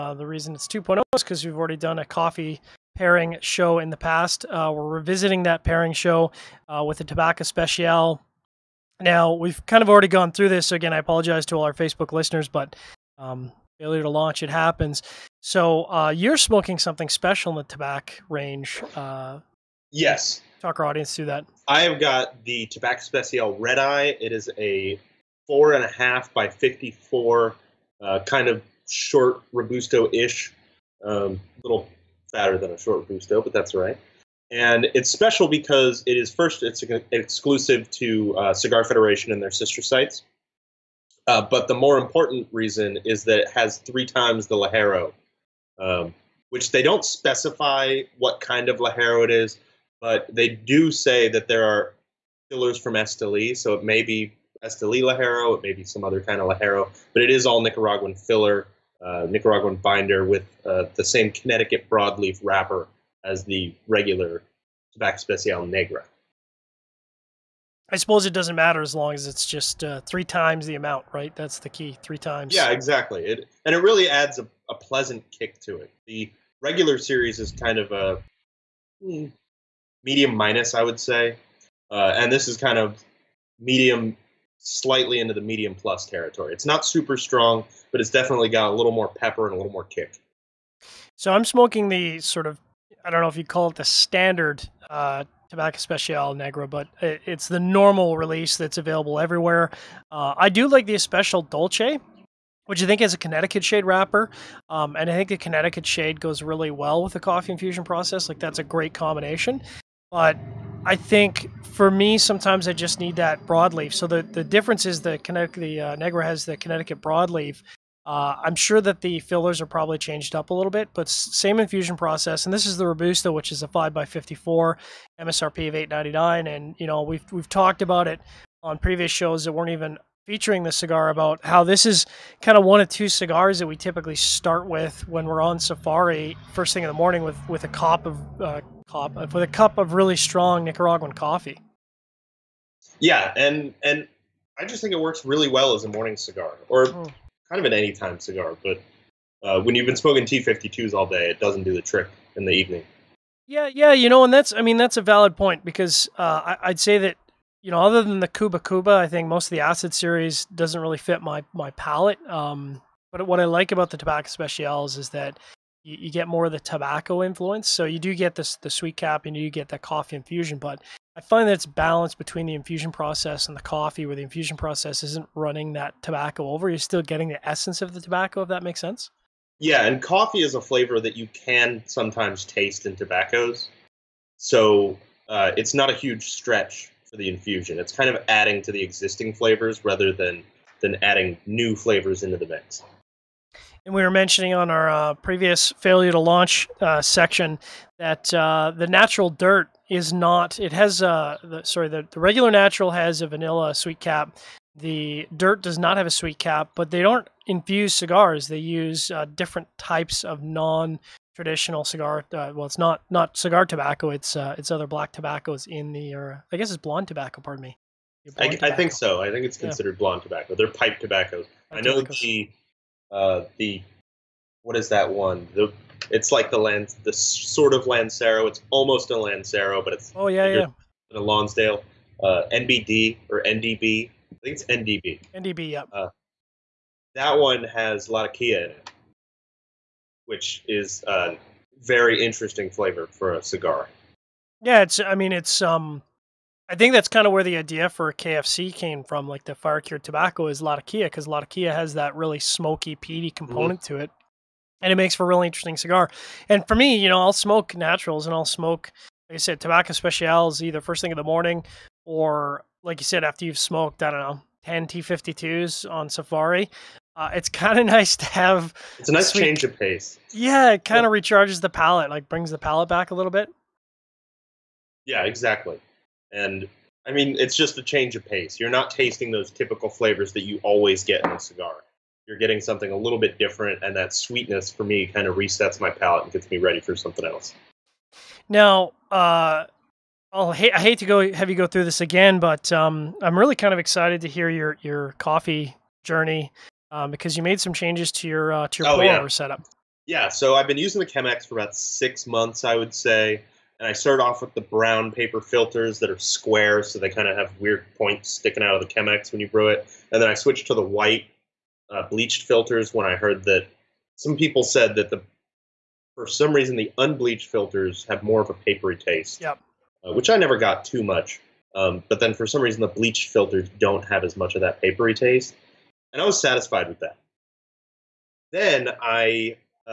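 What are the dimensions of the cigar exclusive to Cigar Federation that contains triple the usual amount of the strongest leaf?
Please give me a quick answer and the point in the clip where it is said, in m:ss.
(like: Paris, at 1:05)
4 1/2 x 54, at 0:25.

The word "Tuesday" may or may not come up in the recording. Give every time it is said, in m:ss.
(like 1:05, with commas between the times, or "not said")
not said.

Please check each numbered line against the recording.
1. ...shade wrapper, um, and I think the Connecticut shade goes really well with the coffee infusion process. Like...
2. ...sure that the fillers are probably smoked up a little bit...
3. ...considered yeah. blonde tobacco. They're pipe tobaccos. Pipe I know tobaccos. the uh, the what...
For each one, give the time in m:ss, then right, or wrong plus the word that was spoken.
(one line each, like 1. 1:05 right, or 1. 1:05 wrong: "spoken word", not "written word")
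1. 1:43 right
2. 1:58 wrong: "changed", not "smoked"
3. 3:39 right.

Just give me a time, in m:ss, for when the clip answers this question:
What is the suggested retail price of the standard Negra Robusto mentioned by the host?
2:05.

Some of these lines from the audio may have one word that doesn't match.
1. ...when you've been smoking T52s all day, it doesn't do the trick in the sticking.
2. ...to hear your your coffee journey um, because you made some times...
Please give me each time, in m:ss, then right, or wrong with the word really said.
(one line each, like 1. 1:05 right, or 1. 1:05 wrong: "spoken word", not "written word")
1. 2:29 wrong: "evening", not "sticking"
2. 4:54 wrong: "changes", not "times".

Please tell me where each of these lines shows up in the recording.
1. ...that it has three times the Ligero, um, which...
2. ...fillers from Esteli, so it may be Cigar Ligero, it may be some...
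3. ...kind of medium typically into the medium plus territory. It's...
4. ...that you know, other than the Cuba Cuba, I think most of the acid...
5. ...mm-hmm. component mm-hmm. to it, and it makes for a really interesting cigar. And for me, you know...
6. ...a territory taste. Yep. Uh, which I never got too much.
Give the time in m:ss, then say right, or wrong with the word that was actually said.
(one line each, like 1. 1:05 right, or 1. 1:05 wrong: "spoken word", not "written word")
1. 0:43 right
2. 0:52 wrong: "Esteli", not "Cigar"
3. 1:22 wrong: "slightly", not "typically"
4. 2:36 right
5. 4:13 right
6. 5:18 wrong: "papery", not "territory".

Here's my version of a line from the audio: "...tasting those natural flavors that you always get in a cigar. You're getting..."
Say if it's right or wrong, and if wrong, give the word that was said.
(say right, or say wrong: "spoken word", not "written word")
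wrong: "typical", not "natural".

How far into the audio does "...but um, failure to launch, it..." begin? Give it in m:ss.
0:12.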